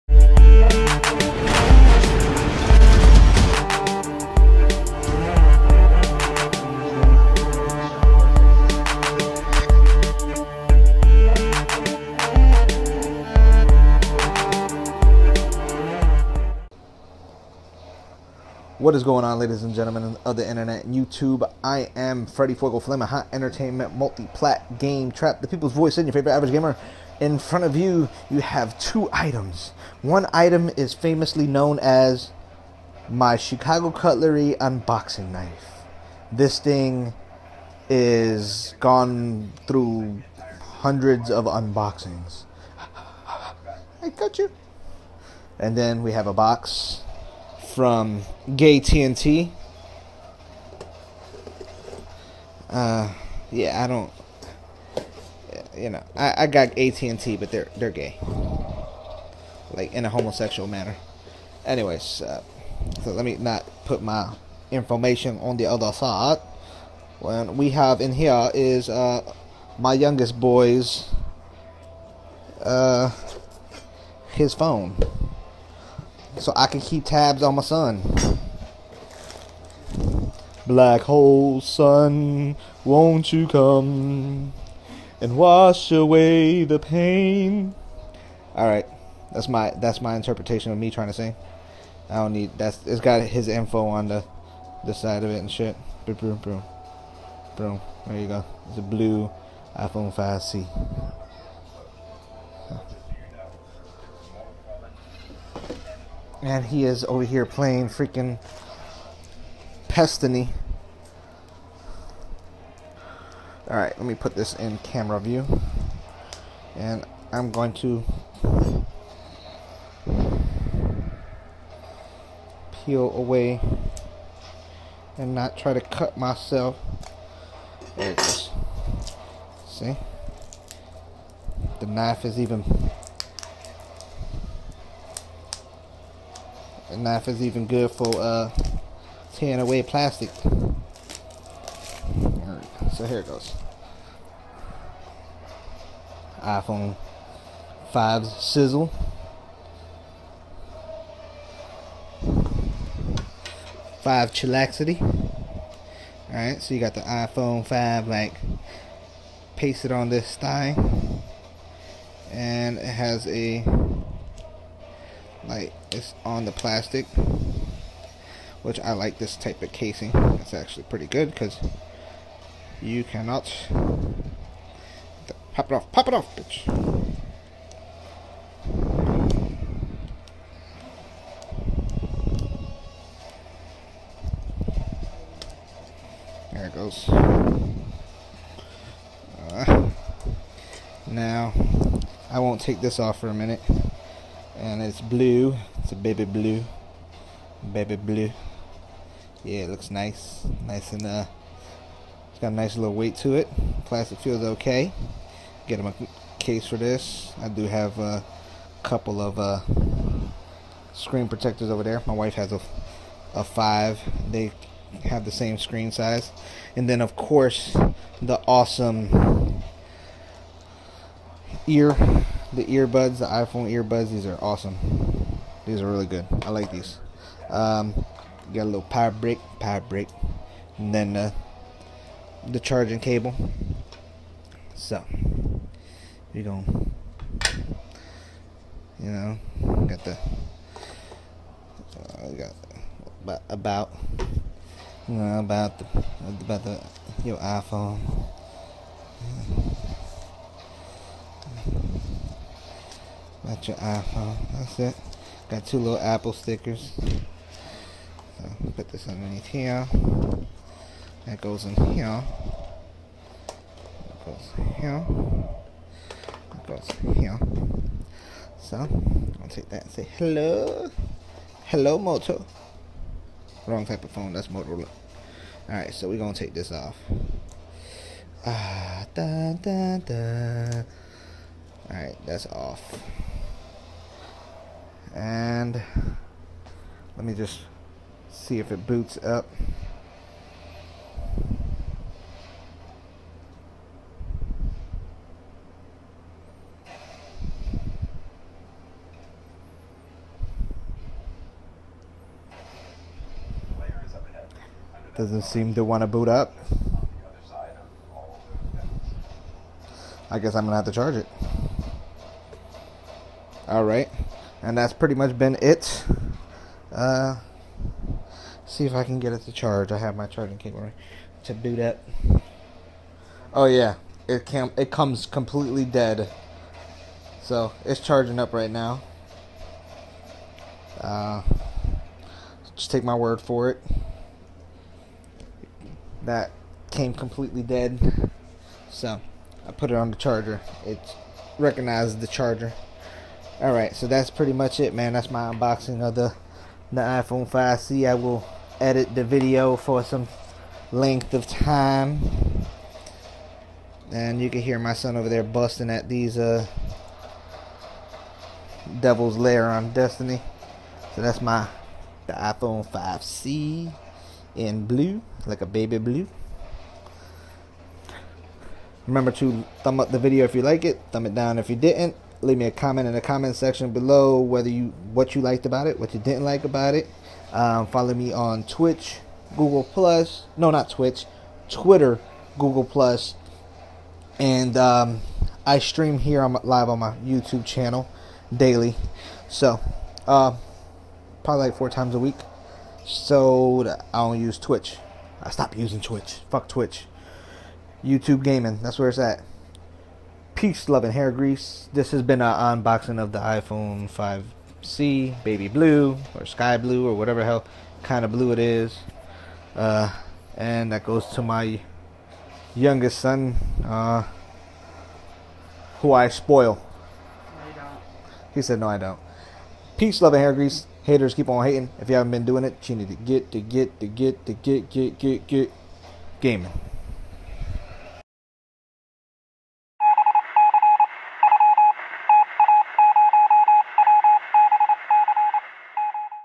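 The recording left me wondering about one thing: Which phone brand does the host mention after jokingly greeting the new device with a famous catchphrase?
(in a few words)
Motorola.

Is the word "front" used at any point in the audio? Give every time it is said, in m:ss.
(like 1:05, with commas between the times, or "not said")
0:27.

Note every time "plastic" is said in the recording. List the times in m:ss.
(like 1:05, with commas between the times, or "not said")
2:19, 2:46, 3:23.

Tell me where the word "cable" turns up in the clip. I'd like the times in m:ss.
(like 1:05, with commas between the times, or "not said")
3:52, 5:20.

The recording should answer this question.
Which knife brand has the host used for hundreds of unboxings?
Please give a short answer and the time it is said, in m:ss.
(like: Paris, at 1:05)
Chicago Cutlery, at 0:33.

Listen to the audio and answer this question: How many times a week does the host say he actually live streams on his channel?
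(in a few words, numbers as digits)
4.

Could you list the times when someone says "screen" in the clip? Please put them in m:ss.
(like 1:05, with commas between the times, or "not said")
3:30, 3:35.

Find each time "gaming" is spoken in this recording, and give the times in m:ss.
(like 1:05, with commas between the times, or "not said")
6:38, 7:06.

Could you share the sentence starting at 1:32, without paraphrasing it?
I don't need that's it's got his info on the the side of it and shit.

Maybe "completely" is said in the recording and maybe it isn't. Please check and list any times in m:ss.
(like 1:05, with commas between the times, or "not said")
5:25, 5:37.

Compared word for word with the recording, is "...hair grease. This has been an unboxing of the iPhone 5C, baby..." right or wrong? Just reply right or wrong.
right.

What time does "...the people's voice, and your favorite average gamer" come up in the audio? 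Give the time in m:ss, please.
0:25.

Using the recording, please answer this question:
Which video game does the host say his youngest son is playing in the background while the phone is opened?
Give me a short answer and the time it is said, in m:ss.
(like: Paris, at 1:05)
Destiny, at 1:49.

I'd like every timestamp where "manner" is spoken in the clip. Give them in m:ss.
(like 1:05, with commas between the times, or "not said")
1:00.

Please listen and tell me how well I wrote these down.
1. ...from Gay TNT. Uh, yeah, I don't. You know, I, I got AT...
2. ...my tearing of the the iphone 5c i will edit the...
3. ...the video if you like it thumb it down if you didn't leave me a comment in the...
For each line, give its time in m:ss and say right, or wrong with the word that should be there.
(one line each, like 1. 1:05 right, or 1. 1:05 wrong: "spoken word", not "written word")
1. 0:47 right
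2. 5:45 wrong: "unboxing", not "tearing"
3. 6:10 right.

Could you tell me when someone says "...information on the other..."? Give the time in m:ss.
1:04.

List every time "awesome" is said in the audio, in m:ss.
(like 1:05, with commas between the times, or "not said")
3:38, 3:44.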